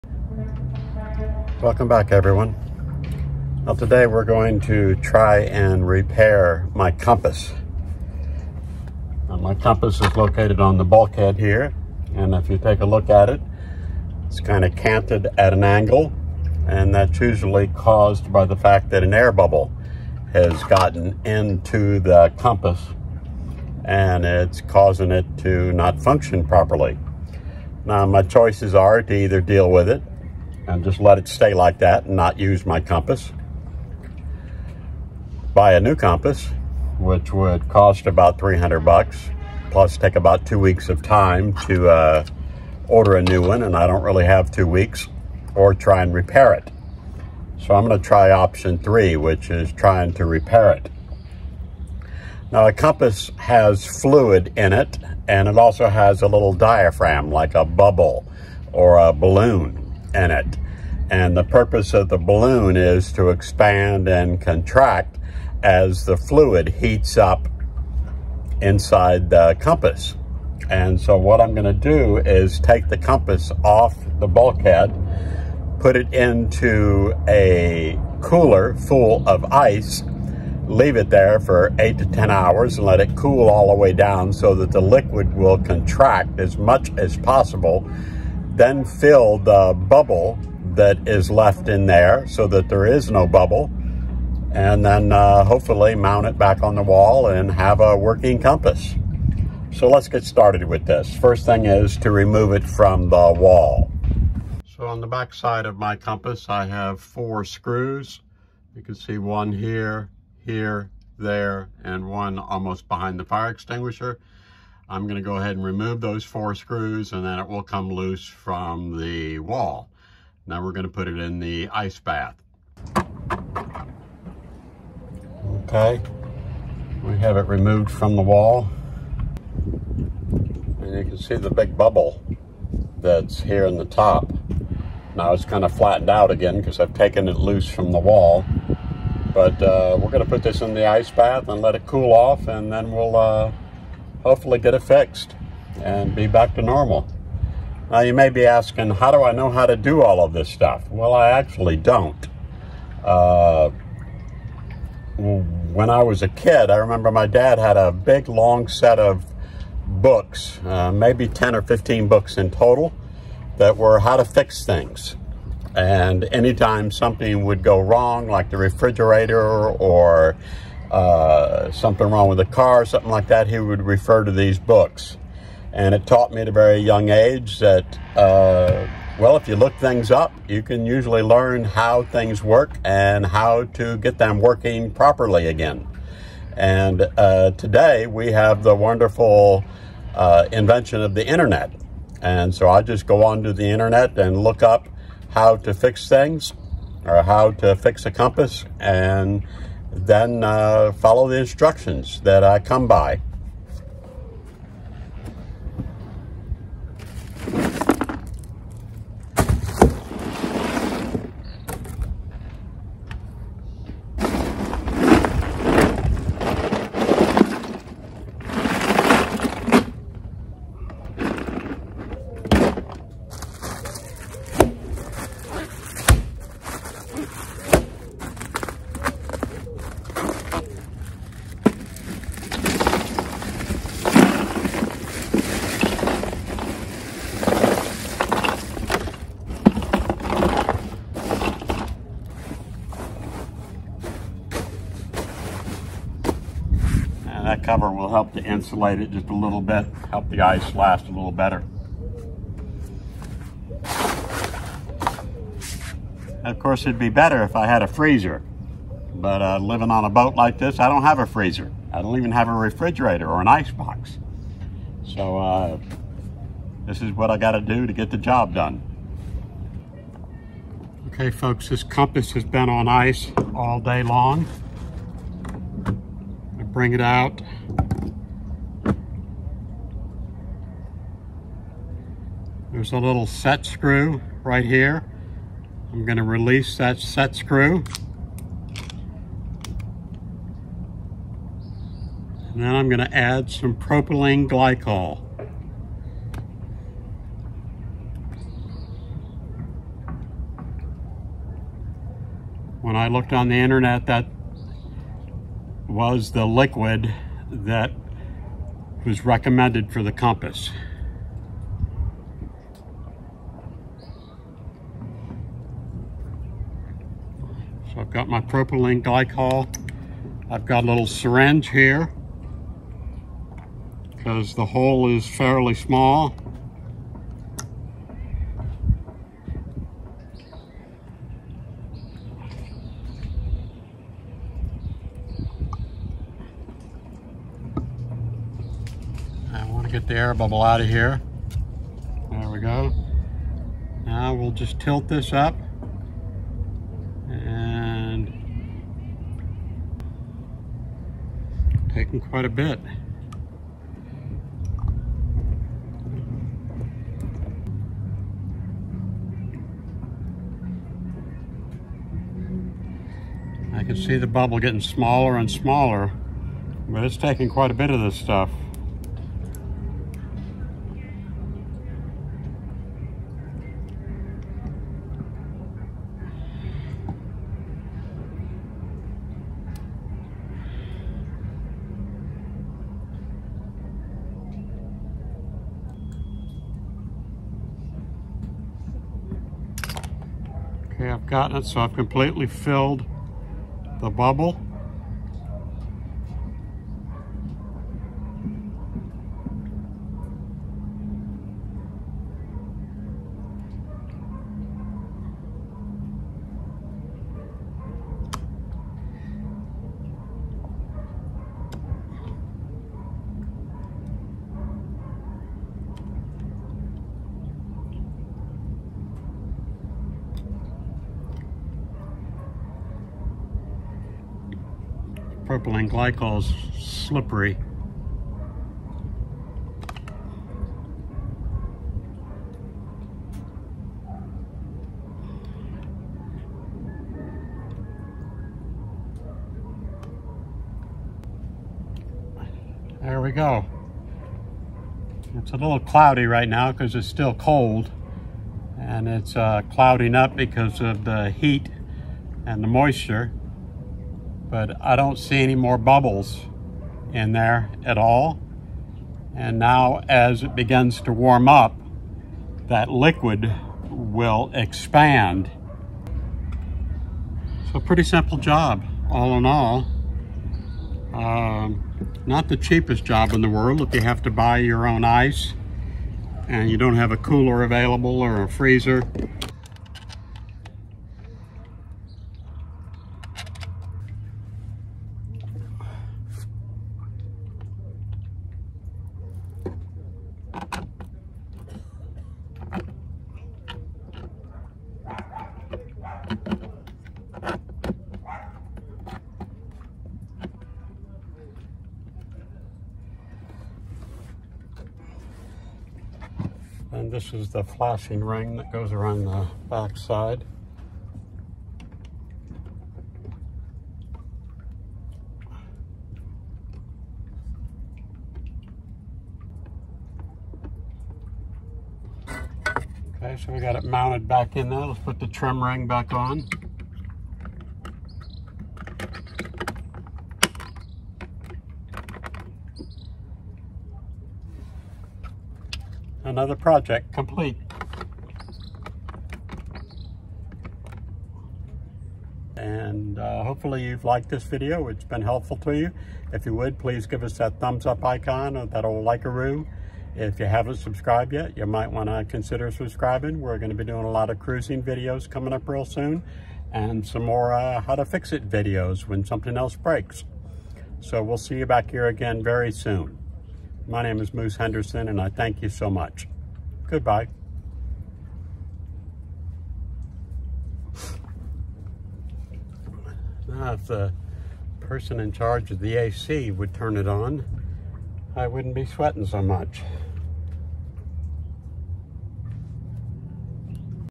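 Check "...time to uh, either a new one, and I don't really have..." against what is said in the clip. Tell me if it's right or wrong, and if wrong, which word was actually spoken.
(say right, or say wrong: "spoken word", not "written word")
wrong: "order", not "either".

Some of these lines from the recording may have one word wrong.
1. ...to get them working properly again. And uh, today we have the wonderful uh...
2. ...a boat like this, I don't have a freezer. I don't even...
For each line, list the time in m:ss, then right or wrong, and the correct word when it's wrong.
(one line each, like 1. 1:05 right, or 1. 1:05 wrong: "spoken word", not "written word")
1. 3:03 right
2. 4:20 right.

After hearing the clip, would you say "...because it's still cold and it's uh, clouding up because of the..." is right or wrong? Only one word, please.
right.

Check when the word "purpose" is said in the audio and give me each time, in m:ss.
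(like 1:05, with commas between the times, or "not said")
1:01.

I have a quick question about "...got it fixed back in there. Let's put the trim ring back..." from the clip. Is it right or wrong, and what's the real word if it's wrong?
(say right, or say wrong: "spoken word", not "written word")
wrong: "mounted", not "fixed".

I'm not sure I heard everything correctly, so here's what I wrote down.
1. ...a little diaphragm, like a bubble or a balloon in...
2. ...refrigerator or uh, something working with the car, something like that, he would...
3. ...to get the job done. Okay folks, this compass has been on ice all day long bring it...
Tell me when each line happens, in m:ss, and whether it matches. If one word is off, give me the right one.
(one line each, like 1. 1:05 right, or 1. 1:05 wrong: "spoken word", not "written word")
1. 0:56 right
2. 2:48 wrong: "wrong", not "working"
3. 4:27 right.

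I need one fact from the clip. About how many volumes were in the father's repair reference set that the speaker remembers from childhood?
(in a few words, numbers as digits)
10 or 15.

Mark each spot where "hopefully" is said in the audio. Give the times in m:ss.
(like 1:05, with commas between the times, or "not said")
1:35, 2:24, 9:03.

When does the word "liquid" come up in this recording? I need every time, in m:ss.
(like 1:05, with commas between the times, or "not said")
1:24, 5:06, 7:42.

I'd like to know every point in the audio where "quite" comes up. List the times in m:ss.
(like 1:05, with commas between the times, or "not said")
5:52, 6:07.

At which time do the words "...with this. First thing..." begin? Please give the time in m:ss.
1:40.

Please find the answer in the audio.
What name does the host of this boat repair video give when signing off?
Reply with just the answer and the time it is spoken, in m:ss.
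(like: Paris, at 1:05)
Moose Henderson, at 9:24.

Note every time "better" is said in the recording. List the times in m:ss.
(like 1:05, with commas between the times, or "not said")
4:11, 4:17.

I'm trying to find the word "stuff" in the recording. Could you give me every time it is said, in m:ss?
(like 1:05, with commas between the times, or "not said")
2:30, 6:08.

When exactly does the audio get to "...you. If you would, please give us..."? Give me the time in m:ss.
9:05.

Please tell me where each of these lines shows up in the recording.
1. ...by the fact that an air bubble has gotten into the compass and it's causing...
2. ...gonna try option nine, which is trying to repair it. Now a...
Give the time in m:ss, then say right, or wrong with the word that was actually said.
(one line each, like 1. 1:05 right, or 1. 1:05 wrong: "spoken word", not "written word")
1. 0:18 right
2. 0:47 wrong: "three", not "nine".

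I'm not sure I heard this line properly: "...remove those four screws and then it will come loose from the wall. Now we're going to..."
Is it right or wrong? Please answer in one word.
right.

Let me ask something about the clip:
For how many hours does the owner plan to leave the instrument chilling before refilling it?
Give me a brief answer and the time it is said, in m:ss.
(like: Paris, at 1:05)
8 to 10 hours, at 1:21.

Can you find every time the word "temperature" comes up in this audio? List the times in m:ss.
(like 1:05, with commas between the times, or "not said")
not said.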